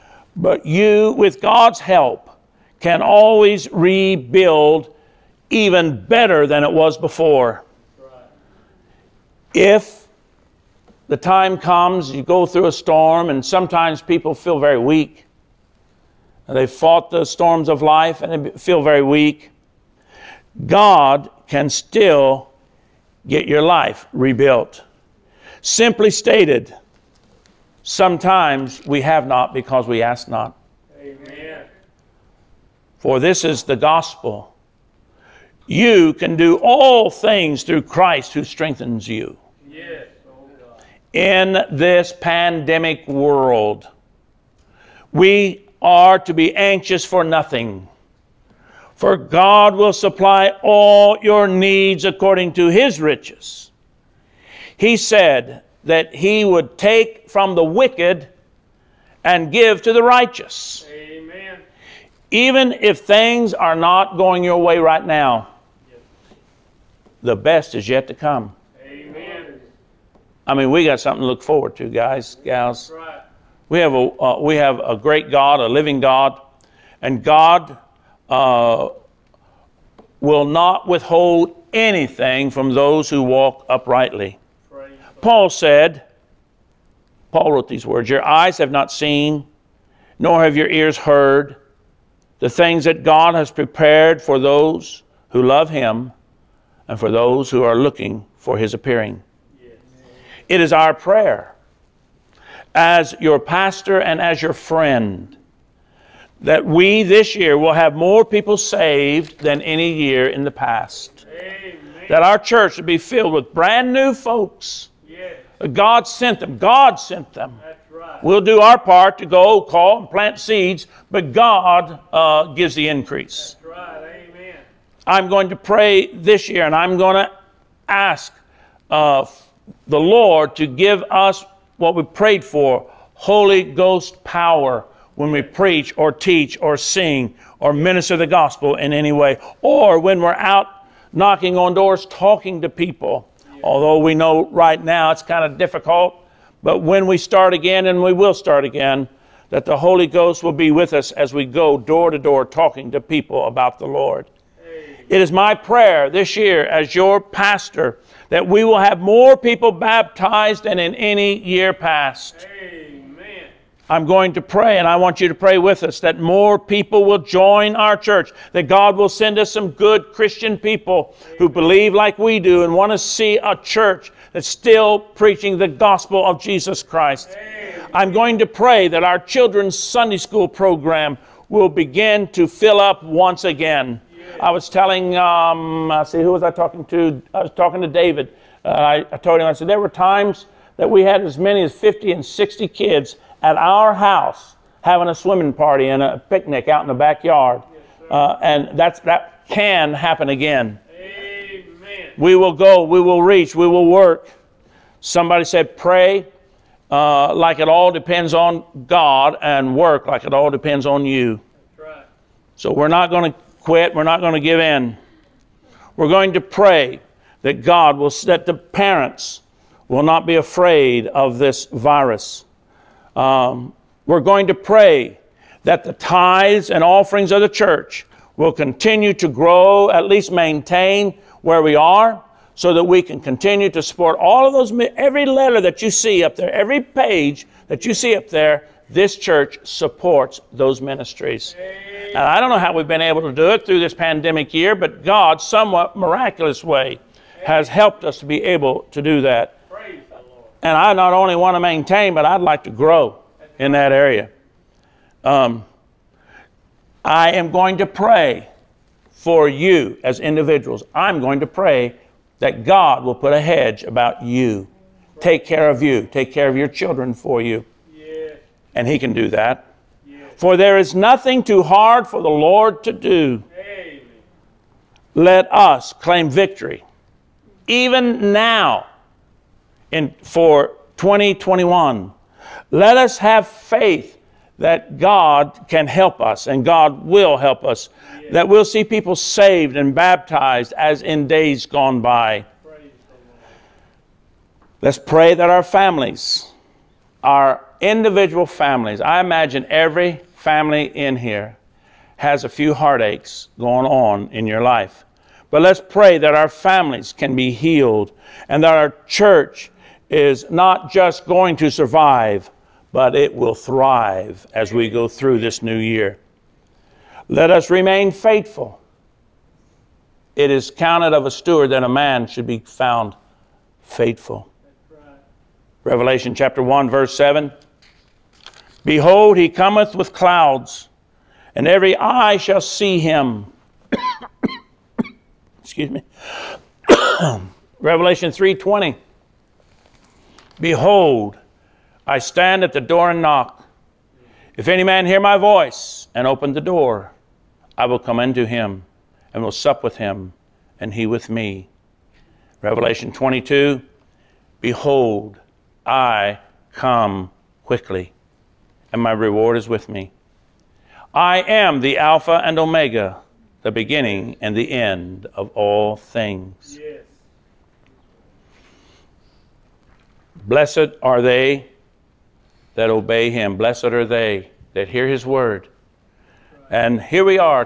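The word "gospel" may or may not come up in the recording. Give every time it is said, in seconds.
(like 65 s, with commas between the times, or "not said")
33 s, 138 s, 175 s.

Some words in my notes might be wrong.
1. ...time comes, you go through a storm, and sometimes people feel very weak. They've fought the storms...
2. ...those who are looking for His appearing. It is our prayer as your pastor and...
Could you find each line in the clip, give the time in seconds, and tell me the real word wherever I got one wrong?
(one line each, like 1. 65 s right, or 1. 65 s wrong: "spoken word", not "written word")
1. 11 s right
2. 97 s right.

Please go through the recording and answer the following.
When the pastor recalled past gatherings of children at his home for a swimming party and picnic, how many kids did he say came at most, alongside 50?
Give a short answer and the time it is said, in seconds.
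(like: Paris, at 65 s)
60, at 192 s.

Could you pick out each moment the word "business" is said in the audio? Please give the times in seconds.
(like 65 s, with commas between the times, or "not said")
not said.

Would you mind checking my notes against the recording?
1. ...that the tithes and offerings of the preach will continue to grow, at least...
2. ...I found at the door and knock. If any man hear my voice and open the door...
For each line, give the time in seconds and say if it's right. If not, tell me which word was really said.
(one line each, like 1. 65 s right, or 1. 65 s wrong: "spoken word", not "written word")
1. 225 s wrong: "church", not "preach"
2. 342 s wrong: "stand", not "found".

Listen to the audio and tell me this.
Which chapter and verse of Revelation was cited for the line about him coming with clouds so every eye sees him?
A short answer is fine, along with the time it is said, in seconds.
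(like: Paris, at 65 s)
Chapter 1, verse 7, at 326 s.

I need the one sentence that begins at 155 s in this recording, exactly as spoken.
It is my prayer this year as your pastor that we will have more people baptized than in any year past.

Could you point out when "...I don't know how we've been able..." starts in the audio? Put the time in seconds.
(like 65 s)
242 s.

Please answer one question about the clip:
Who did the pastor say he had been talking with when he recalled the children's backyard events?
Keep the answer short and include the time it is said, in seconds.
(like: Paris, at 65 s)
David, at 187 s.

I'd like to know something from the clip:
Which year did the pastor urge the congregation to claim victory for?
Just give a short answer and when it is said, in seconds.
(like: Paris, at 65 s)
2021, at 280 s.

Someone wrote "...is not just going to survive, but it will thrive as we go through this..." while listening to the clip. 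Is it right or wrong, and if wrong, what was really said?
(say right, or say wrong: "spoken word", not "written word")
right.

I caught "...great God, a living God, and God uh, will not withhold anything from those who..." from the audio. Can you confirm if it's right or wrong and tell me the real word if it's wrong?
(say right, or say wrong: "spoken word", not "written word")
right.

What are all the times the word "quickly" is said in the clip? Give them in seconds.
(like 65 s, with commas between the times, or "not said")
357 s.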